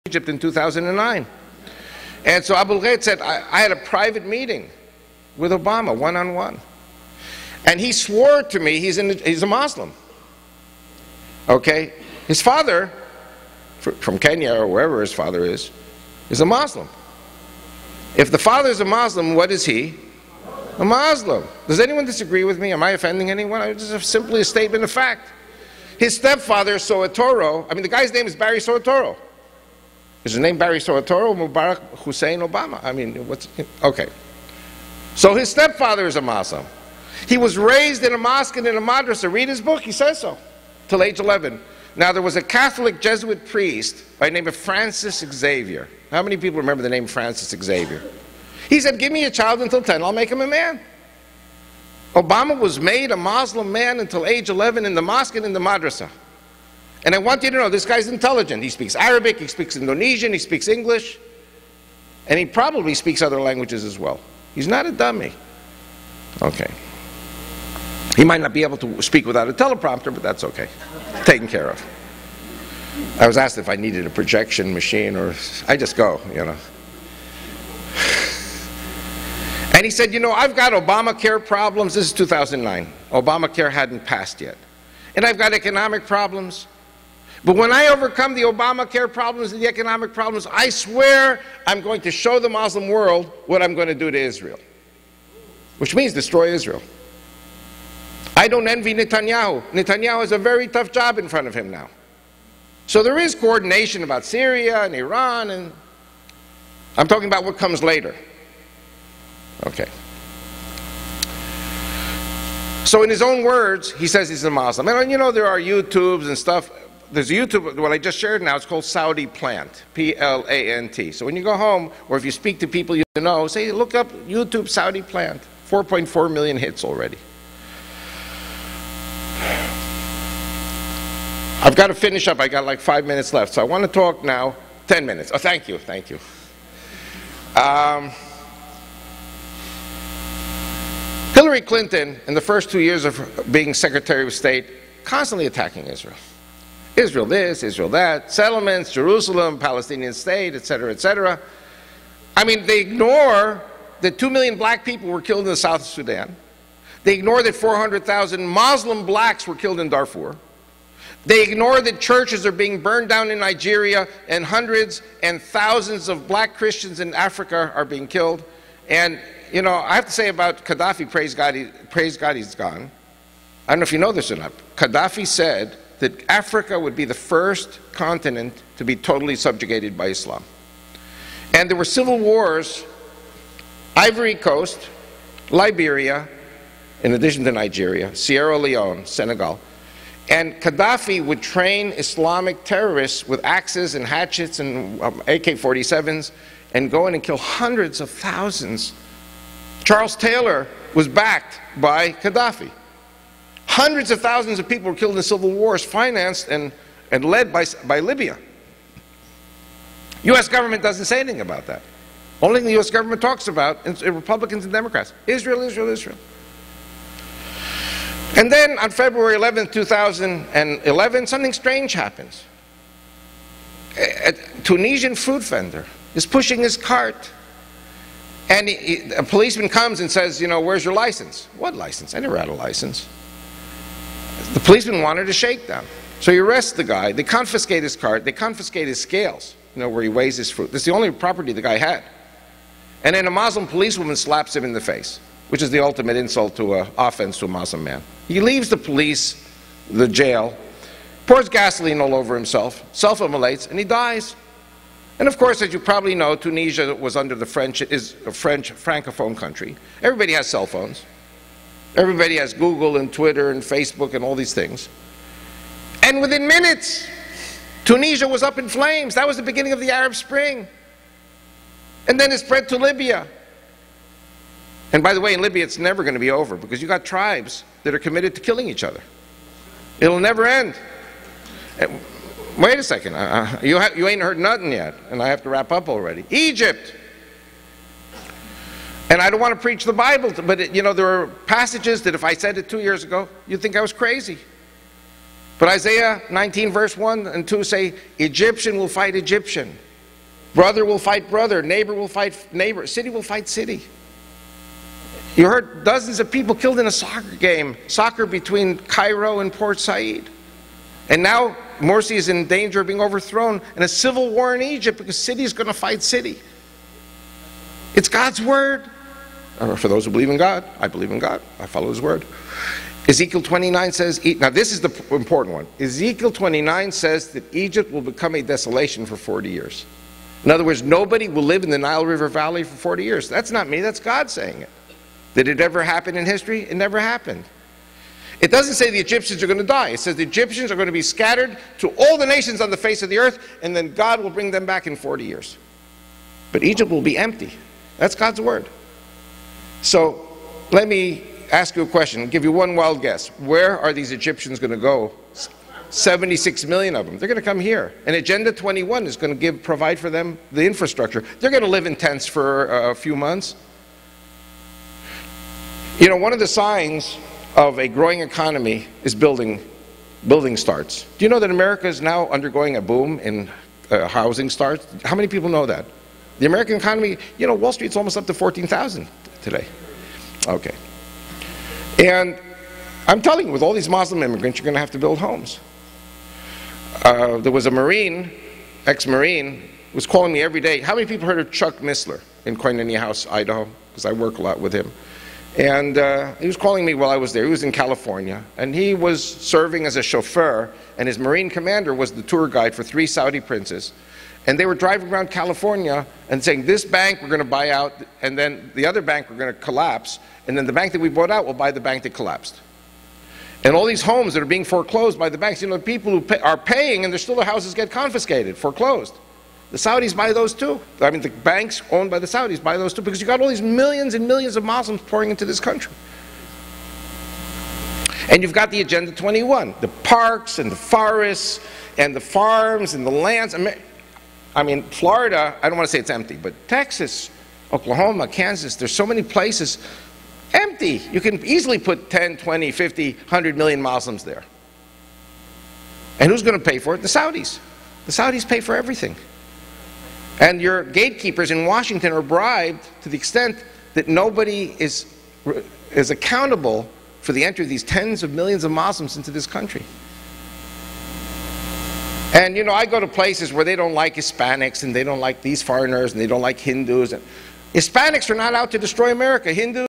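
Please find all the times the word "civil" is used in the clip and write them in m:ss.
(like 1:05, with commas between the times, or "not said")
3:01, 3:25, 5:13.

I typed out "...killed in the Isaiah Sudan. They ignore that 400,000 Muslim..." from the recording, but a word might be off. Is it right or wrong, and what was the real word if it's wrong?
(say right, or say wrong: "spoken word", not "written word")
wrong: "South", not "Isaiah".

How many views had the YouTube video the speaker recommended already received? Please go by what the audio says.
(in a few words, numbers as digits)
4.4 million.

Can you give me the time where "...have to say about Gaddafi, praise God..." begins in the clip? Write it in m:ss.
2:49.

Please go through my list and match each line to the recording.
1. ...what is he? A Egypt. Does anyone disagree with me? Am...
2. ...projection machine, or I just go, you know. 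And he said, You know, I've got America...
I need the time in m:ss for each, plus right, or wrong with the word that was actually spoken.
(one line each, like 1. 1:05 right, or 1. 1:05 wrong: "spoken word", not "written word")
1. 0:19 wrong: "Muslim", not "Egypt"
2. 1:14 wrong: "Obamacare", not "America".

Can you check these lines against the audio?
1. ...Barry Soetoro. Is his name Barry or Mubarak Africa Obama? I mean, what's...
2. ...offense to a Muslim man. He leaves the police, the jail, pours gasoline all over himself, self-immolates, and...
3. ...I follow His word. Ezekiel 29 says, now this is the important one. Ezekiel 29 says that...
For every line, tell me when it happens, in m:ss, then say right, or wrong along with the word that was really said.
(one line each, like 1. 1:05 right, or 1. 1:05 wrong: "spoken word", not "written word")
1. 0:28 wrong: "Hussein", not "Africa"
2. 4:06 right
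3. 5:21 right.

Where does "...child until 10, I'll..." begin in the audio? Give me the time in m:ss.
0:49.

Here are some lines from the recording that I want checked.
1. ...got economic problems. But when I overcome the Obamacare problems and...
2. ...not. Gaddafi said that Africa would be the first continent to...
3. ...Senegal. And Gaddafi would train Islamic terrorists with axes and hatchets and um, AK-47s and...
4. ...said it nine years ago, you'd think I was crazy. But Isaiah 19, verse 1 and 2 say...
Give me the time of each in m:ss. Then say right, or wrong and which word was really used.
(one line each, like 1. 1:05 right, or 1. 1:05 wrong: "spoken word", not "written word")
1. 1:25 right
2. 2:54 right
3. 3:09 right
4. 4:52 wrong: "two", not "nine".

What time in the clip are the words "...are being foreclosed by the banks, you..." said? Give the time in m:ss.
6:54.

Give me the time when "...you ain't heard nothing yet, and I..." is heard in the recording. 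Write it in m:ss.
4:43.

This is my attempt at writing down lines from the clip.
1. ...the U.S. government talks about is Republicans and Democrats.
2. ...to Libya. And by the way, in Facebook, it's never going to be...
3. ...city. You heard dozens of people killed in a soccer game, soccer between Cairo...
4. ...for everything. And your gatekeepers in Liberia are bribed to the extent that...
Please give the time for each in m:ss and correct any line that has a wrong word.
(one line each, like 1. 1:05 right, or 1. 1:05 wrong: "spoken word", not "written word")
1. 3:32 right
2. 4:32 wrong: "Libya", not "Facebook"
3. 5:03 right
4. 7:28 wrong: "Washington", not "Liberia".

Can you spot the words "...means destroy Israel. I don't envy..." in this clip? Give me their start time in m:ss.
1:35.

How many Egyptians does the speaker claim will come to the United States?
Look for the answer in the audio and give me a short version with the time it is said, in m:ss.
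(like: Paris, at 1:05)
76 million, at 5:55.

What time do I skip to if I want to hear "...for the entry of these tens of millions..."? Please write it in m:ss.
7:37.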